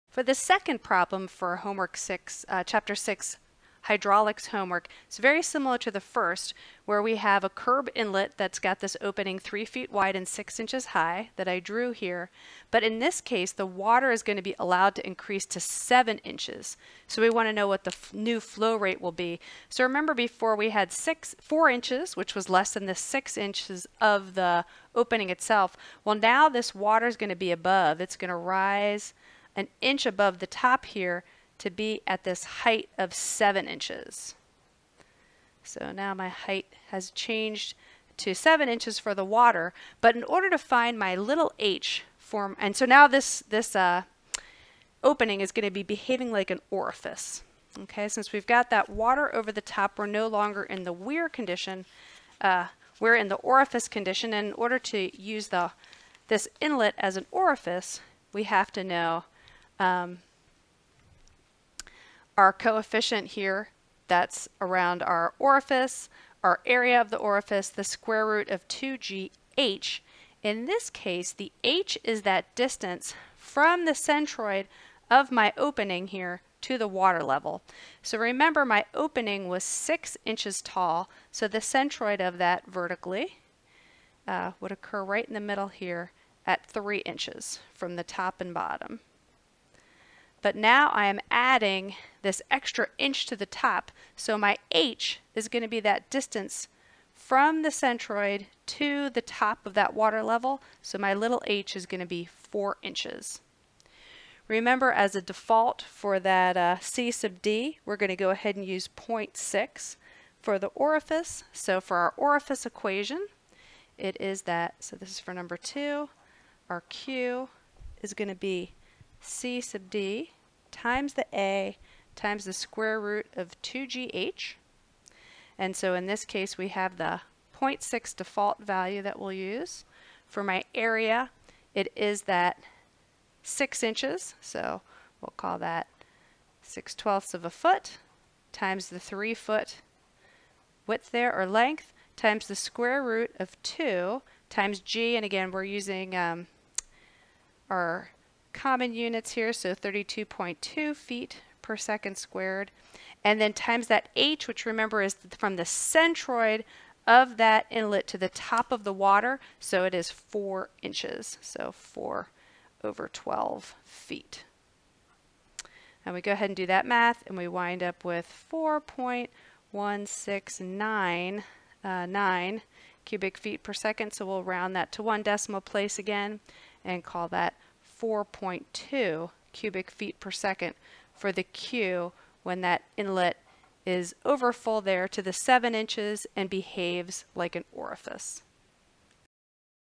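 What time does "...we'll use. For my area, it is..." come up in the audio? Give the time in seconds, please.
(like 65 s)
129 s.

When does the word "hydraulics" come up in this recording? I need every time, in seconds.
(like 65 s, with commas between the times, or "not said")
3 s.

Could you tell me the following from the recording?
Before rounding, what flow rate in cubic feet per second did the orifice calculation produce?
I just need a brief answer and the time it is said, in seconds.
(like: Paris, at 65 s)
4.1699, at 168 s.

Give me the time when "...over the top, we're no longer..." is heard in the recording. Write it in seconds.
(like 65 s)
49 s.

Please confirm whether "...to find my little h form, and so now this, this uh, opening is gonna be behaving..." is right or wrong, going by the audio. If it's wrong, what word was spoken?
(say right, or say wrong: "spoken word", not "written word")
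right.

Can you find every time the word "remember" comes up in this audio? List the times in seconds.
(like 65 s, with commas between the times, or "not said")
19 s, 78 s, 104 s, 154 s.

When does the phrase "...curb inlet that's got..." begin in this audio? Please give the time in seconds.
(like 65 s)
7 s.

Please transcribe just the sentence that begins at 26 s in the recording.
Well, now this water is going to be above.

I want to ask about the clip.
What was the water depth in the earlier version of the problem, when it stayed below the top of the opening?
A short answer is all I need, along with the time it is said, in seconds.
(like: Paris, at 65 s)
4 inches, at 21 s.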